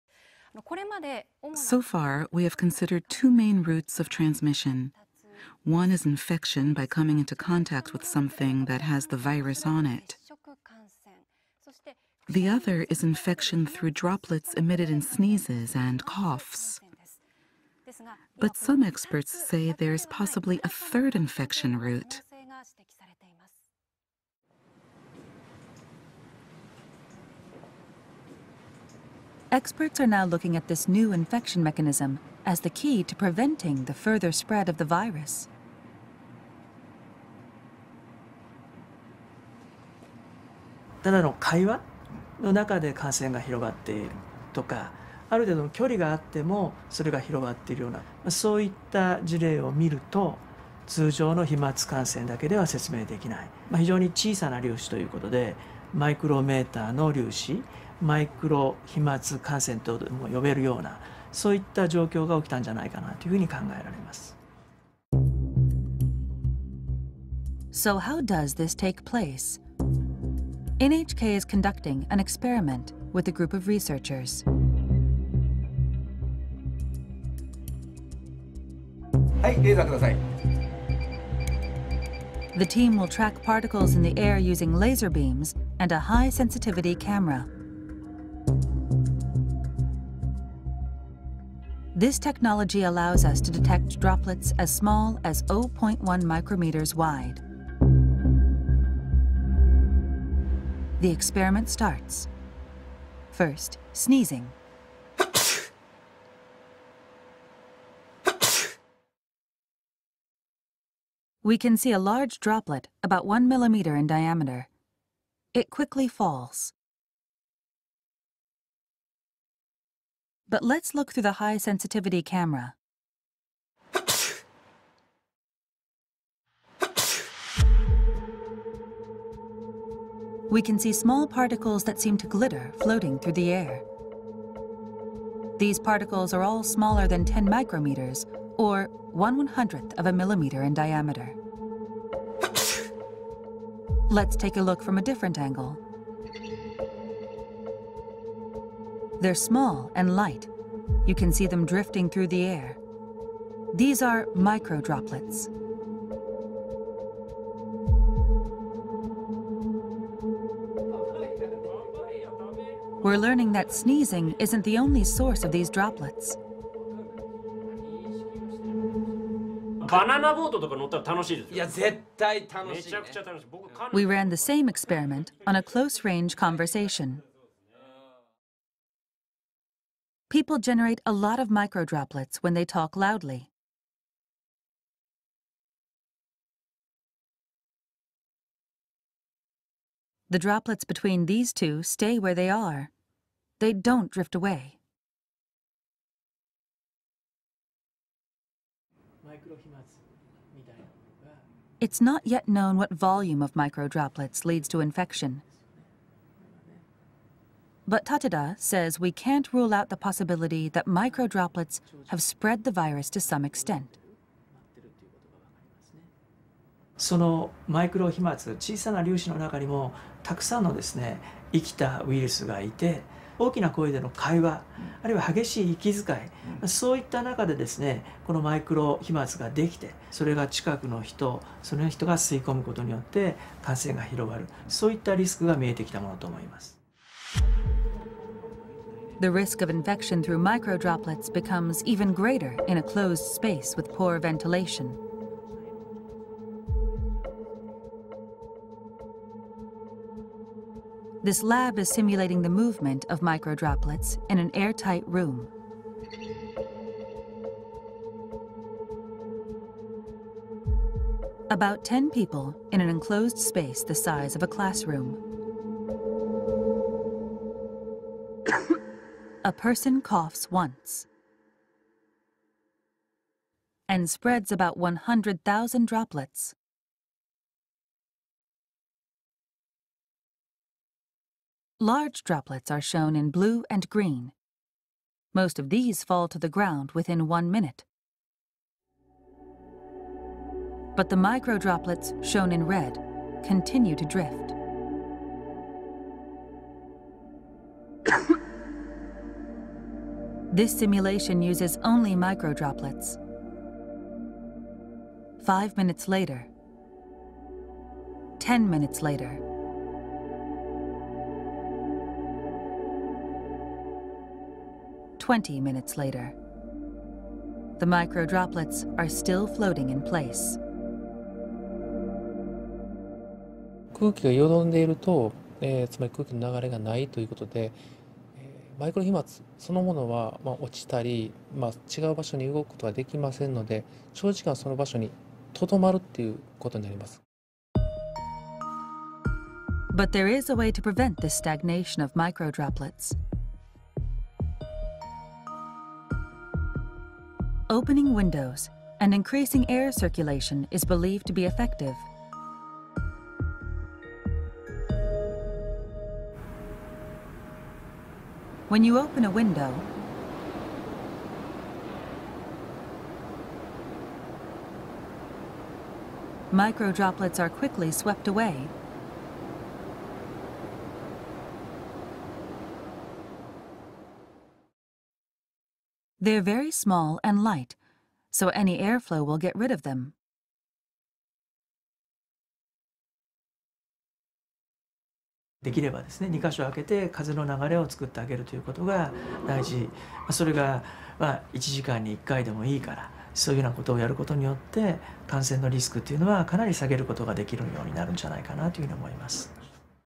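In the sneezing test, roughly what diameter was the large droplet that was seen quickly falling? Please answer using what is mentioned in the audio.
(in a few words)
1 millimeter.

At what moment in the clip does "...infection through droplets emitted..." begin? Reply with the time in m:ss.
0:13.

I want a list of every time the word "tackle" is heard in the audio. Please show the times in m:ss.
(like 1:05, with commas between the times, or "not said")
not said.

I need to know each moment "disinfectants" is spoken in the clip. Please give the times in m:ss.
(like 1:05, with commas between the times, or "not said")
not said.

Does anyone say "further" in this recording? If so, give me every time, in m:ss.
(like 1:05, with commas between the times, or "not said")
0:33.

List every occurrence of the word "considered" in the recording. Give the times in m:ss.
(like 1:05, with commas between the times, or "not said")
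0:02.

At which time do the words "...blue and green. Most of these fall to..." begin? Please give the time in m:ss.
4:43.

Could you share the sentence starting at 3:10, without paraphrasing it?
The droplets between these two stay where they are.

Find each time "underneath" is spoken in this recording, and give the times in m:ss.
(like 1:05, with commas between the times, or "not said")
not said.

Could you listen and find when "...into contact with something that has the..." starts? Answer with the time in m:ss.
0:07.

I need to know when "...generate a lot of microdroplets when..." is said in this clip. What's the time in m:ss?
3:00.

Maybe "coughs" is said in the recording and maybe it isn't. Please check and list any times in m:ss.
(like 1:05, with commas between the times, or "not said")
0:16, 4:30.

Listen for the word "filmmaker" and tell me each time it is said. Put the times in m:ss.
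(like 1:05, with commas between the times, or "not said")
not said.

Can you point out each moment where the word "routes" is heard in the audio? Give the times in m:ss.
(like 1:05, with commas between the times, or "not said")
0:03, 0:21.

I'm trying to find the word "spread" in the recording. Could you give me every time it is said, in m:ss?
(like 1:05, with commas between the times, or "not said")
0:34, 3:32, 4:34.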